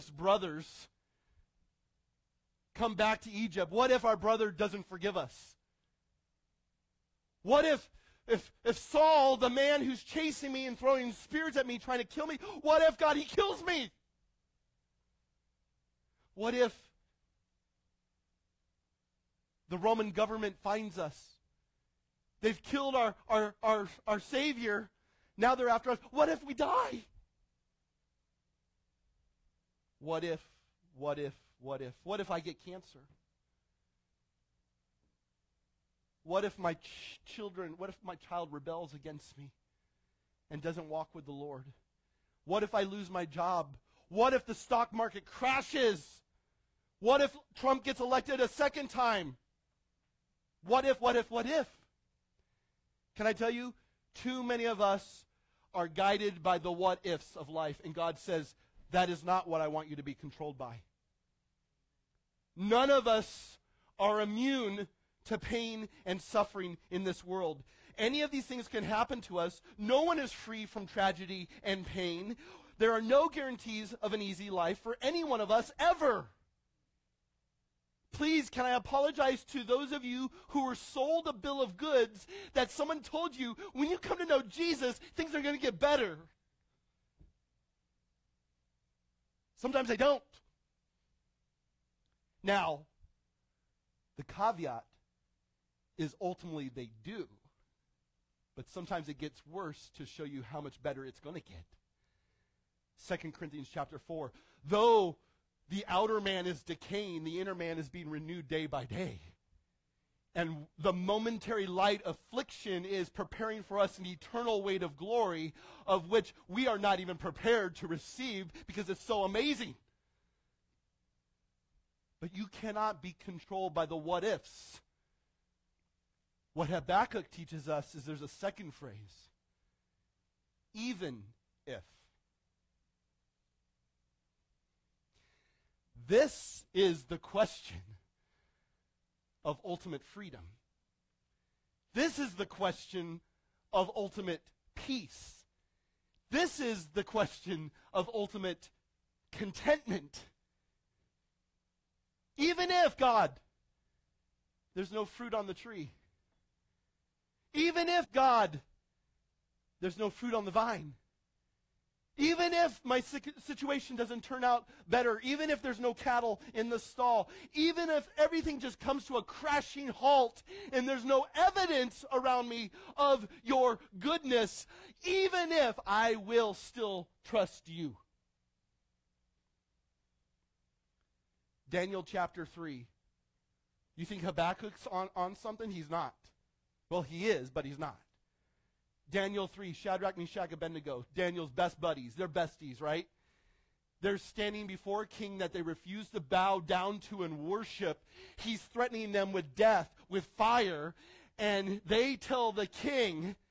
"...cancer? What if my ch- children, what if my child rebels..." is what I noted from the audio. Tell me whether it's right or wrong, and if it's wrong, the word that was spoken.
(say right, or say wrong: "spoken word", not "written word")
right.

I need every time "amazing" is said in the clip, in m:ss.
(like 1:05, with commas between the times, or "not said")
1:59.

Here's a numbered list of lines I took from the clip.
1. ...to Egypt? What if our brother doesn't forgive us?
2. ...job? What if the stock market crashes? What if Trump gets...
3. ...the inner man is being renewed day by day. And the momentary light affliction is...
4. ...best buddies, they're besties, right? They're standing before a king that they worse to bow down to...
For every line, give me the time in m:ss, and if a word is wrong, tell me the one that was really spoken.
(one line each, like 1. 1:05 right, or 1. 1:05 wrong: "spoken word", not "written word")
1. 0:03 right
2. 0:43 right
3. 1:47 right
4. 3:11 wrong: "refuse", not "worse".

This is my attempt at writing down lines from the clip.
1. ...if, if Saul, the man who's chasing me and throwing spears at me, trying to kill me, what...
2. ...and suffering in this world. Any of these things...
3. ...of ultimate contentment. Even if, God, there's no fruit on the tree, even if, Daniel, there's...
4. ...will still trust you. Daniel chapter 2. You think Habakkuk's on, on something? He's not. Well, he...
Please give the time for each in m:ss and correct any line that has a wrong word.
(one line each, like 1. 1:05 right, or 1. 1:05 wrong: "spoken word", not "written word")
1. 0:08 right
2. 1:06 right
3. 2:27 wrong: "God", not "Daniel"
4. 2:56 wrong: "3", not "2".